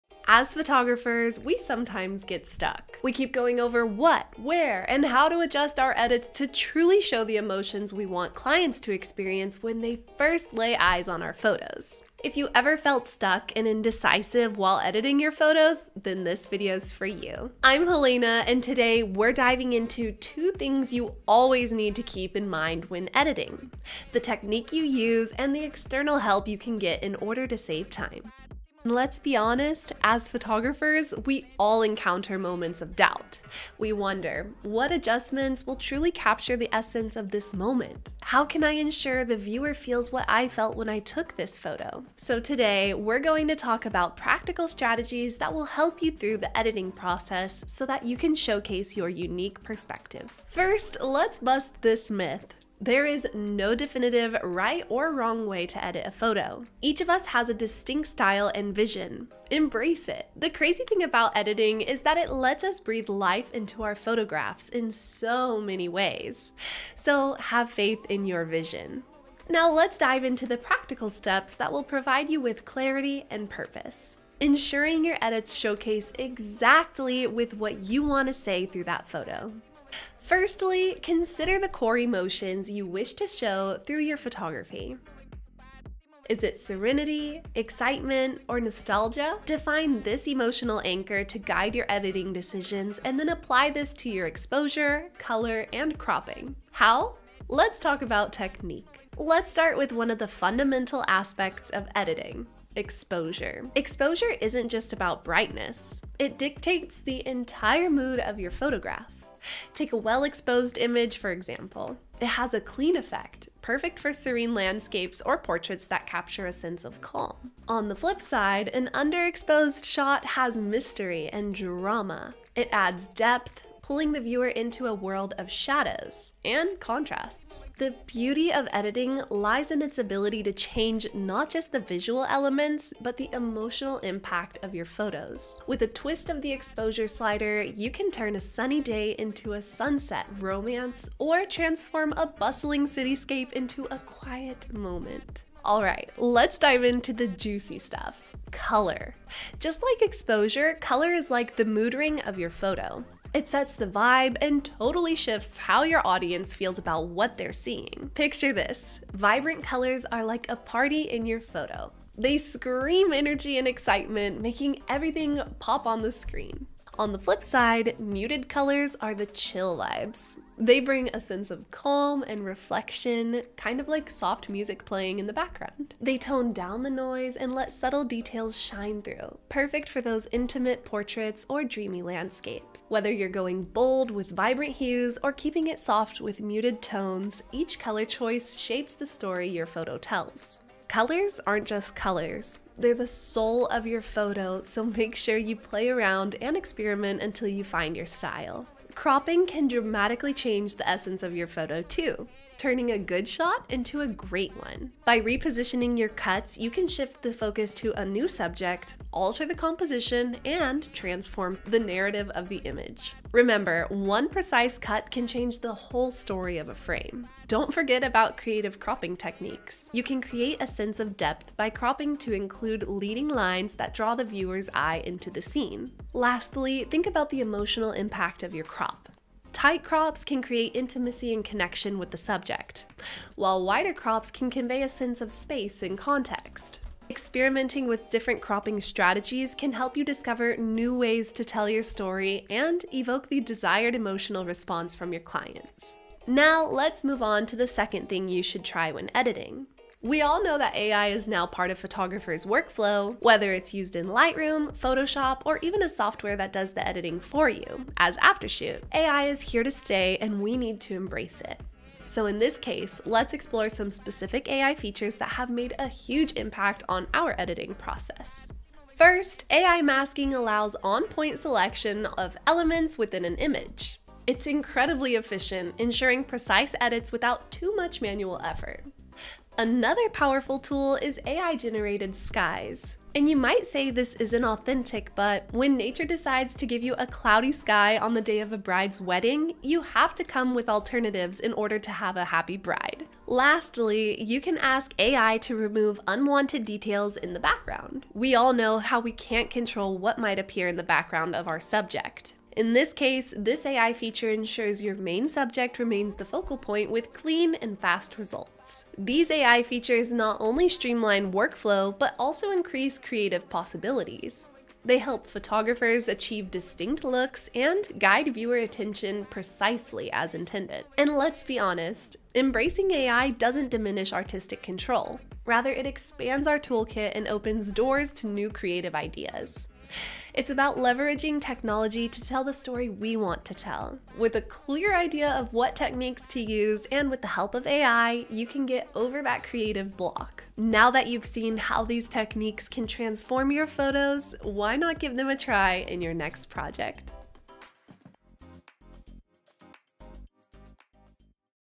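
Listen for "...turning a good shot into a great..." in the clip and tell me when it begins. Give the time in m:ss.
3:22.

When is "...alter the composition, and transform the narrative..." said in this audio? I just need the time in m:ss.
3:29.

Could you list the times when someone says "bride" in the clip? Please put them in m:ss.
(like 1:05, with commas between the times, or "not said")
4:48, 4:52.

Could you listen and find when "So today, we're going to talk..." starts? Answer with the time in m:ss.
0:42.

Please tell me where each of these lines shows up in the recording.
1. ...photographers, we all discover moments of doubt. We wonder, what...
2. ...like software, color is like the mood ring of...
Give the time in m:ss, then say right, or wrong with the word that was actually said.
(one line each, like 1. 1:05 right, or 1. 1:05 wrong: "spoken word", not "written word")
1. 0:30 wrong: "encounter", not "discover"
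2. 2:29 wrong: "exposure", not "software".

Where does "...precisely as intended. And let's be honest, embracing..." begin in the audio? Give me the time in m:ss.
5:19.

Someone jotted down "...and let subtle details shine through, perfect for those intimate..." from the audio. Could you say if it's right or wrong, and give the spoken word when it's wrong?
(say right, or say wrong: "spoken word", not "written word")
right.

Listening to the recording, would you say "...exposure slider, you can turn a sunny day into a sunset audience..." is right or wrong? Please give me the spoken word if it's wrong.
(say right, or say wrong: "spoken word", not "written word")
wrong: "romance", not "audience".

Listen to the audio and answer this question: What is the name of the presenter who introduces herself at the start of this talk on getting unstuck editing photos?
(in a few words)
Helena.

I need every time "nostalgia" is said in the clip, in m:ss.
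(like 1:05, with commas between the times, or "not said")
1:28.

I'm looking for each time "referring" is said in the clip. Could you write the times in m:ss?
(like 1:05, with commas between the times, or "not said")
not said.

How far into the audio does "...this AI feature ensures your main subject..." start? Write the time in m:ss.
5:03.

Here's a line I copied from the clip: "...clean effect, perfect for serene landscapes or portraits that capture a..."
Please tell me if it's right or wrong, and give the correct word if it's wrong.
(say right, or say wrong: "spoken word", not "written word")
right.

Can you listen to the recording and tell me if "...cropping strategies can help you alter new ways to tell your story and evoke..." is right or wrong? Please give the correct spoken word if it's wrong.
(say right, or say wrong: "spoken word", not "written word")
wrong: "discover", not "alter".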